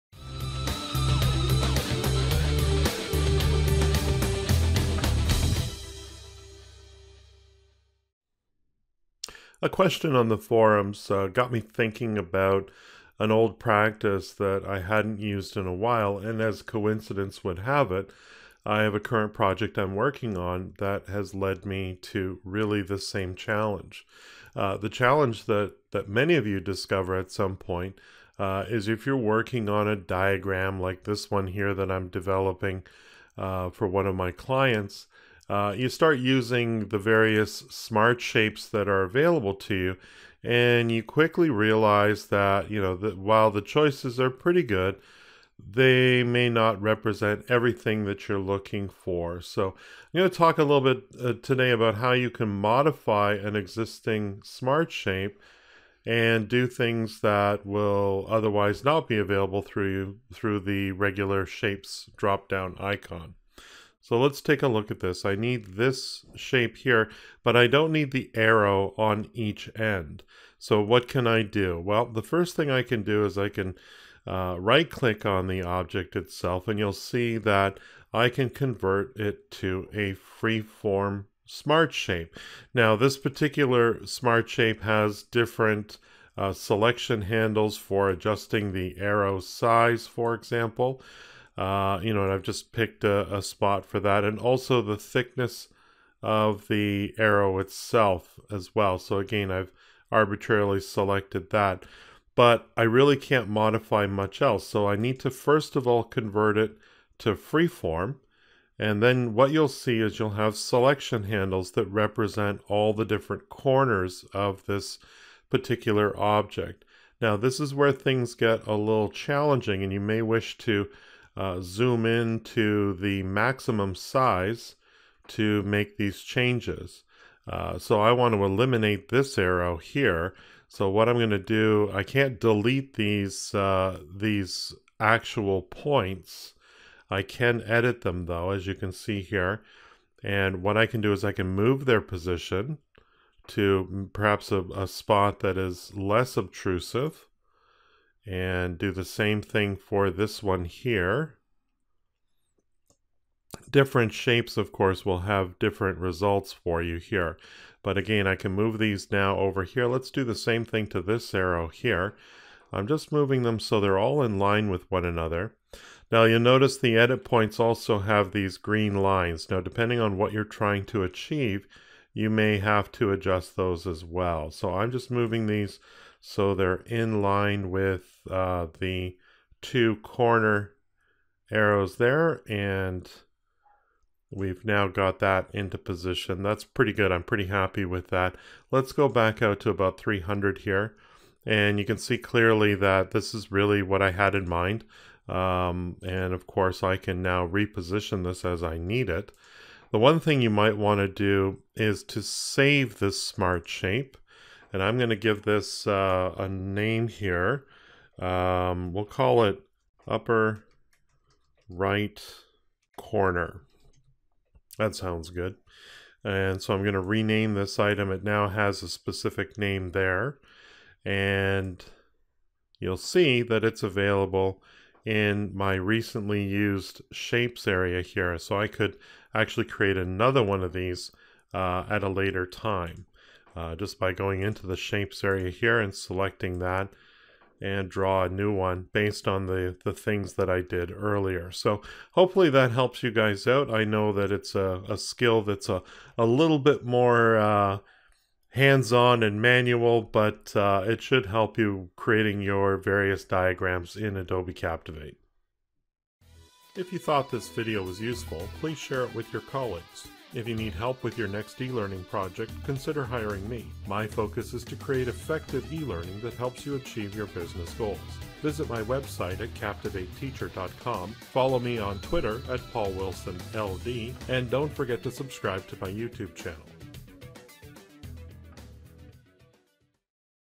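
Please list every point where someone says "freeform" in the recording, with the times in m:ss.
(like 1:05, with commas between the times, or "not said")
1:20, 1:47.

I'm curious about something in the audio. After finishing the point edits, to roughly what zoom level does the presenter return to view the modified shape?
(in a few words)
300.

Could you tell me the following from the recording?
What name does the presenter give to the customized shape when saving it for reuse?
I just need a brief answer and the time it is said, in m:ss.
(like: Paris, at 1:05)
upper right corner, at 3:30.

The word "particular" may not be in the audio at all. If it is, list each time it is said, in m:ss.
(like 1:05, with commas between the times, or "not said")
1:23, 1:55.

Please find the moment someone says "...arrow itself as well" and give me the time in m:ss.
1:37.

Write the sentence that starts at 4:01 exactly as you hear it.
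So hopefully that helps you guys out.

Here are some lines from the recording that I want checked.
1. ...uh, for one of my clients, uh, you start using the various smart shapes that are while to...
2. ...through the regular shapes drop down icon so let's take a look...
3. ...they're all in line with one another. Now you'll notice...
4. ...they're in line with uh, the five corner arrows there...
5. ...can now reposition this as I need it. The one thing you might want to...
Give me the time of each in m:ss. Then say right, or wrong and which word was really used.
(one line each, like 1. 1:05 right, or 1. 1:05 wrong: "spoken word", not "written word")
1. 0:33 wrong: "available", not "while"
2. 1:00 right
3. 2:43 right
4. 2:56 wrong: "two", not "five"
5. 3:16 right.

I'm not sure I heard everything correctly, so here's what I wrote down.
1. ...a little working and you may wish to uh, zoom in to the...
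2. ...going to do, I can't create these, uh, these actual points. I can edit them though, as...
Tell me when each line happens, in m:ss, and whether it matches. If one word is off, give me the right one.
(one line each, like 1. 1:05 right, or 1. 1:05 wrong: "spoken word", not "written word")
1. 1:58 wrong: "challenging", not "working"
2. 2:11 wrong: "delete", not "create".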